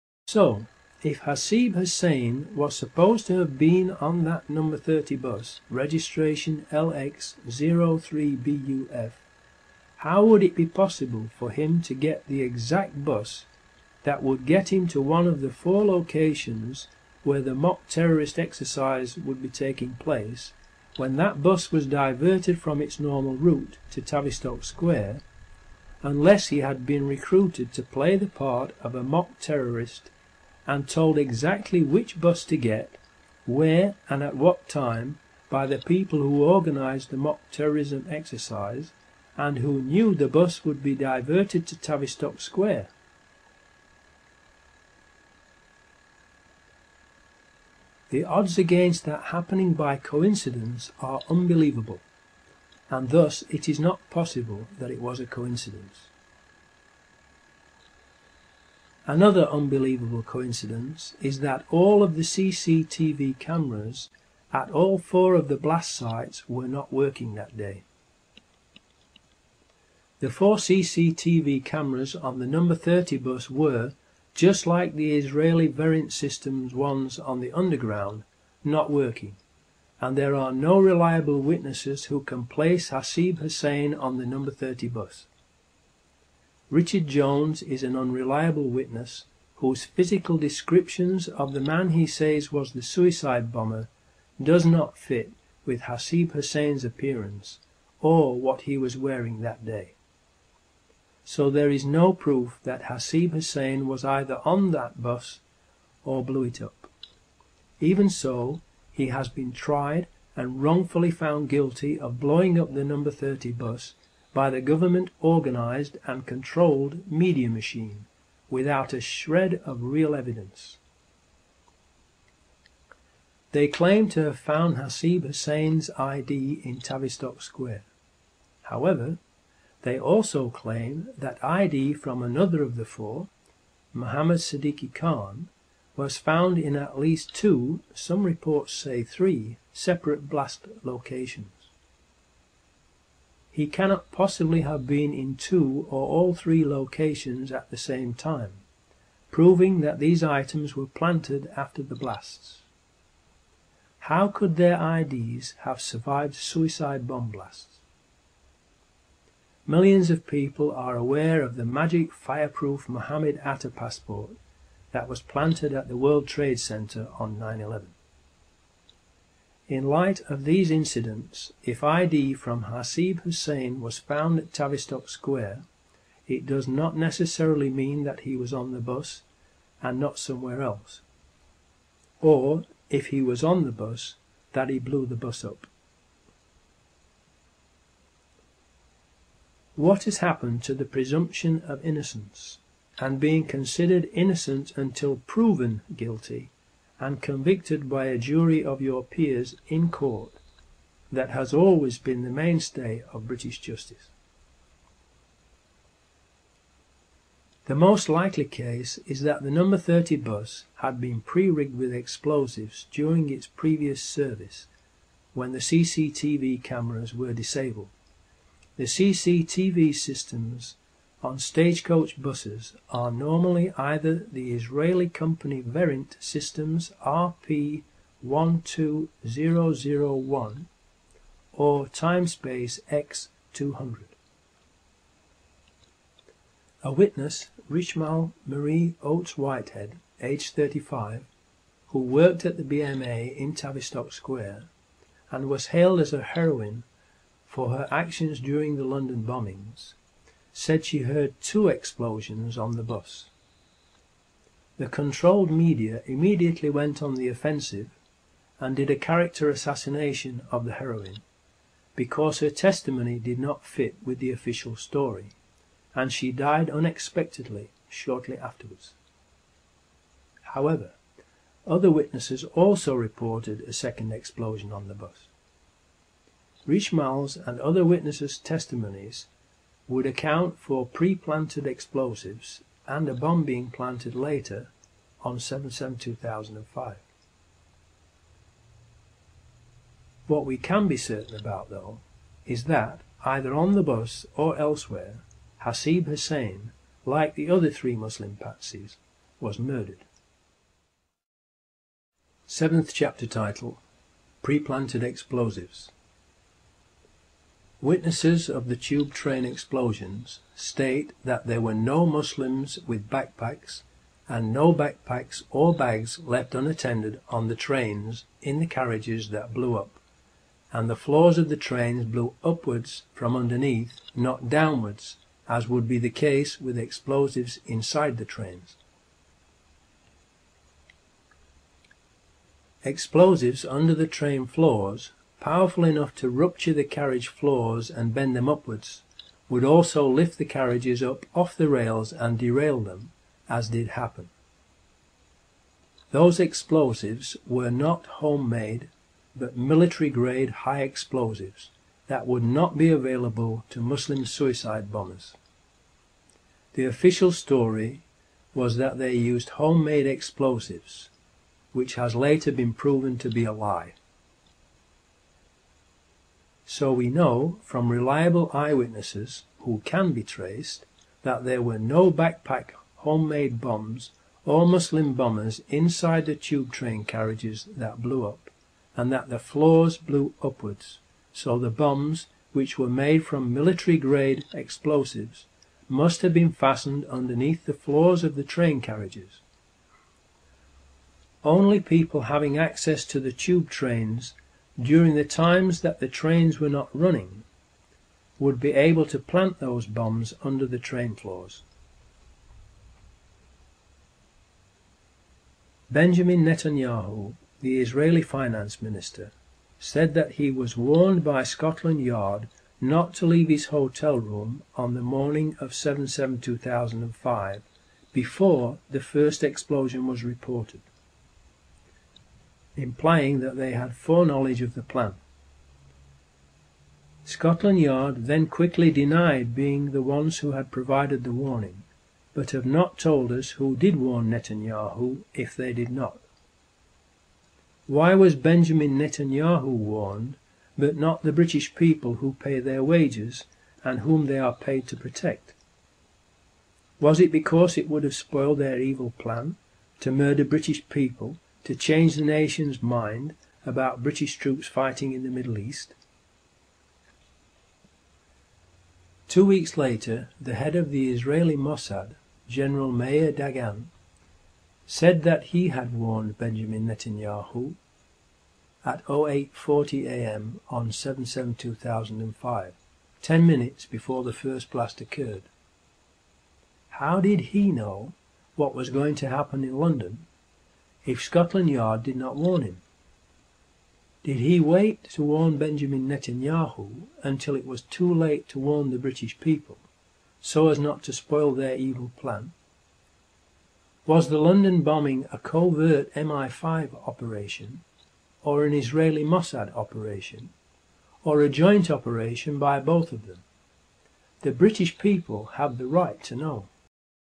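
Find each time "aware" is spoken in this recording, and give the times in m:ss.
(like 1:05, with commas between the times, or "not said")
2:40.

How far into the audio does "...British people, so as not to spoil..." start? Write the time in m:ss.
8:08.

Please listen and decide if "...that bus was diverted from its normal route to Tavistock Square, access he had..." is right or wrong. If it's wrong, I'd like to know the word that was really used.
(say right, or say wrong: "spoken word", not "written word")
wrong: "unless", not "access".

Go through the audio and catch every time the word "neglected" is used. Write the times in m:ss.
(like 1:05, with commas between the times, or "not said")
not said.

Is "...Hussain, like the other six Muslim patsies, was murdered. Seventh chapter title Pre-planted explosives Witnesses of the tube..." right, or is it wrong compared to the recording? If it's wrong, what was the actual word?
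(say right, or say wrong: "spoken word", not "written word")
wrong: "three", not "six".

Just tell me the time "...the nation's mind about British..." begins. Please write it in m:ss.
7:32.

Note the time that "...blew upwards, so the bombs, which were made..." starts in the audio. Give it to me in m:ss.
6:19.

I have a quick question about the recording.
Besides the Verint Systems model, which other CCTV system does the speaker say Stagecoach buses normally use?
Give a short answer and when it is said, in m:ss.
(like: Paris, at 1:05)
Timespace X200, at 3:51.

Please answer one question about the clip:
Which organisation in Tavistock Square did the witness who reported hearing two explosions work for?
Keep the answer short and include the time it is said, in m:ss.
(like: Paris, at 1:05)
BMA, at 4:02.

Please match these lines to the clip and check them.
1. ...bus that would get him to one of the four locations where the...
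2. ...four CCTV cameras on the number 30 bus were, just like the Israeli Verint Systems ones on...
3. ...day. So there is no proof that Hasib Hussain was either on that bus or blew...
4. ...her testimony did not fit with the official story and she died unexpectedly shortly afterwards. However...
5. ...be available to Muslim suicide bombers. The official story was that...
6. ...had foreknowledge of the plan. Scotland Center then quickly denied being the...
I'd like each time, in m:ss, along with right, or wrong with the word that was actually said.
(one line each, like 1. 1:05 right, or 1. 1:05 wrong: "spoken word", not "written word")
1. 0:13 right
2. 1:10 right
3. 1:39 right
4. 4:22 right
5. 5:52 right
6. 7:03 wrong: "Yard", not "Center".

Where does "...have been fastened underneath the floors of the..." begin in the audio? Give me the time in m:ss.
6:26.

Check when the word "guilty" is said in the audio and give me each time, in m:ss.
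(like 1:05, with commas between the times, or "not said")
1:51, 3:15.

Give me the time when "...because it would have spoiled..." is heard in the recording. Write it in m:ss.
7:27.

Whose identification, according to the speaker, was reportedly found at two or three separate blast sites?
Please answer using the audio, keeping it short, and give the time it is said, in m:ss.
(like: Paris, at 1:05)
Muhammad Sidique Khan, at 2:13.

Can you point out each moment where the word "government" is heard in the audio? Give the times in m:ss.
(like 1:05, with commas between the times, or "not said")
1:54.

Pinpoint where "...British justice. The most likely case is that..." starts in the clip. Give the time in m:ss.
3:23.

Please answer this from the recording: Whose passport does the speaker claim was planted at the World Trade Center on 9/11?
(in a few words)
Mohammed Atta.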